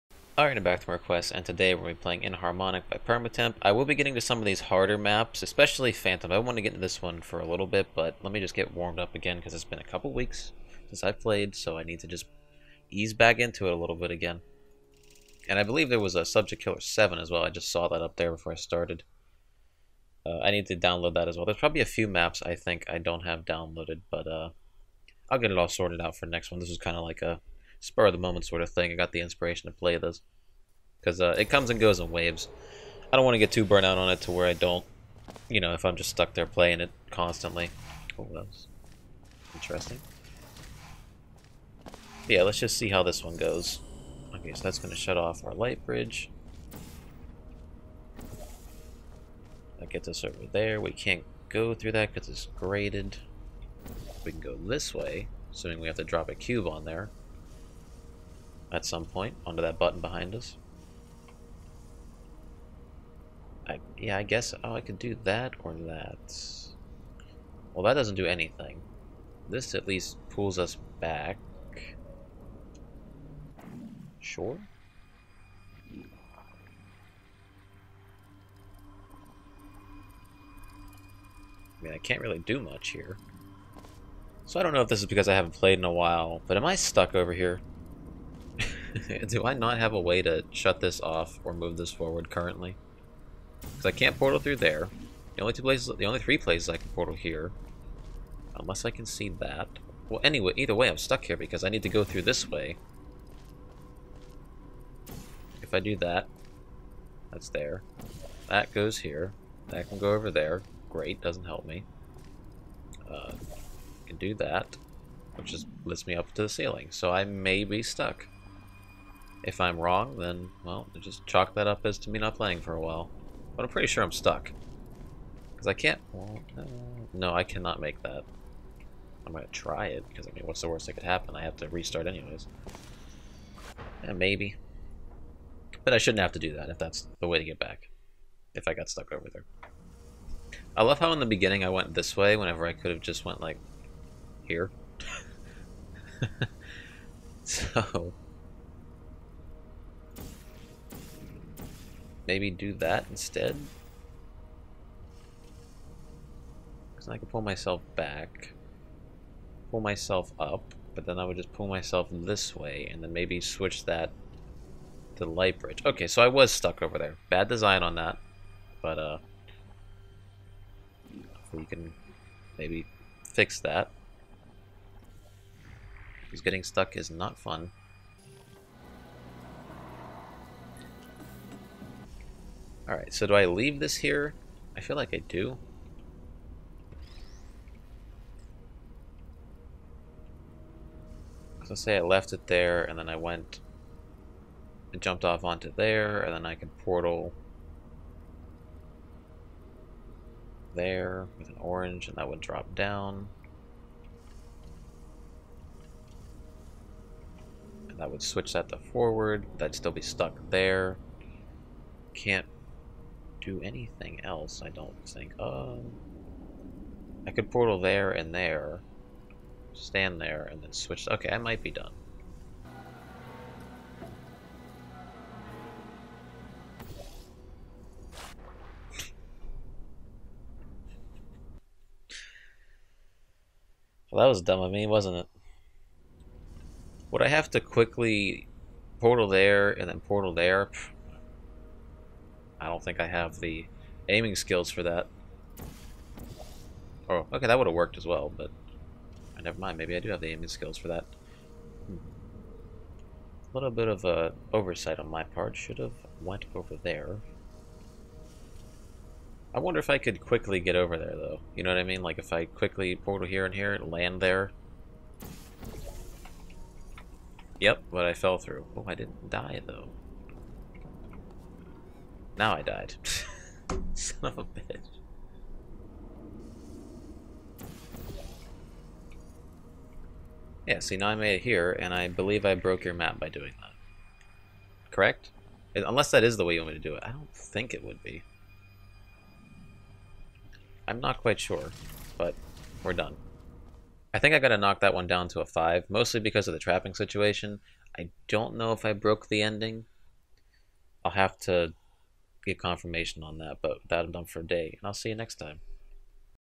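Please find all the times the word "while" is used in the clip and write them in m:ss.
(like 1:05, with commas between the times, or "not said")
1:25, 2:02.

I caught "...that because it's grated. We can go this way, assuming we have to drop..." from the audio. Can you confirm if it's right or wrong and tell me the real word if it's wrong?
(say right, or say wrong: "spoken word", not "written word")
right.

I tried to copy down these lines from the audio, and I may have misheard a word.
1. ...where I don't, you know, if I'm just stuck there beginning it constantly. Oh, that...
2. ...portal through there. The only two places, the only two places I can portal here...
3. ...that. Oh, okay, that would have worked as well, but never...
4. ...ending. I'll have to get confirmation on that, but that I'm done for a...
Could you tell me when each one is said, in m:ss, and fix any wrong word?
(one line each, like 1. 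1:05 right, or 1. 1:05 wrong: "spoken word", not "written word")
1. 0:34 wrong: "playing", not "beginning"
2. 1:34 wrong: "three", not "two"
3. 4:04 right
4. 4:59 right.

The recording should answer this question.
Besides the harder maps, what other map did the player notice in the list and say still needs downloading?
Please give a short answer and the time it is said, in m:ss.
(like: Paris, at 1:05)
Subject Killer 7, at 0:16.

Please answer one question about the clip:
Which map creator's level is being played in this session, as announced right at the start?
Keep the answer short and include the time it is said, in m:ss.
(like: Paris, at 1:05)
Permatemp, at 0:02.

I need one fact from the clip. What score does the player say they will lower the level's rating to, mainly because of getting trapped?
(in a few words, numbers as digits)
5.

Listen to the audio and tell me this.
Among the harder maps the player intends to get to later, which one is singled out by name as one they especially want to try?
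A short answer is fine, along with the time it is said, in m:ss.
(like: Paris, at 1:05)
Phantom, at 0:05.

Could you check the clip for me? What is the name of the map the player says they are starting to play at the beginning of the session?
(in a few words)
Inharmonic.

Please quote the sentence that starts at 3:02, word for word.
Alright, so do I leave this here?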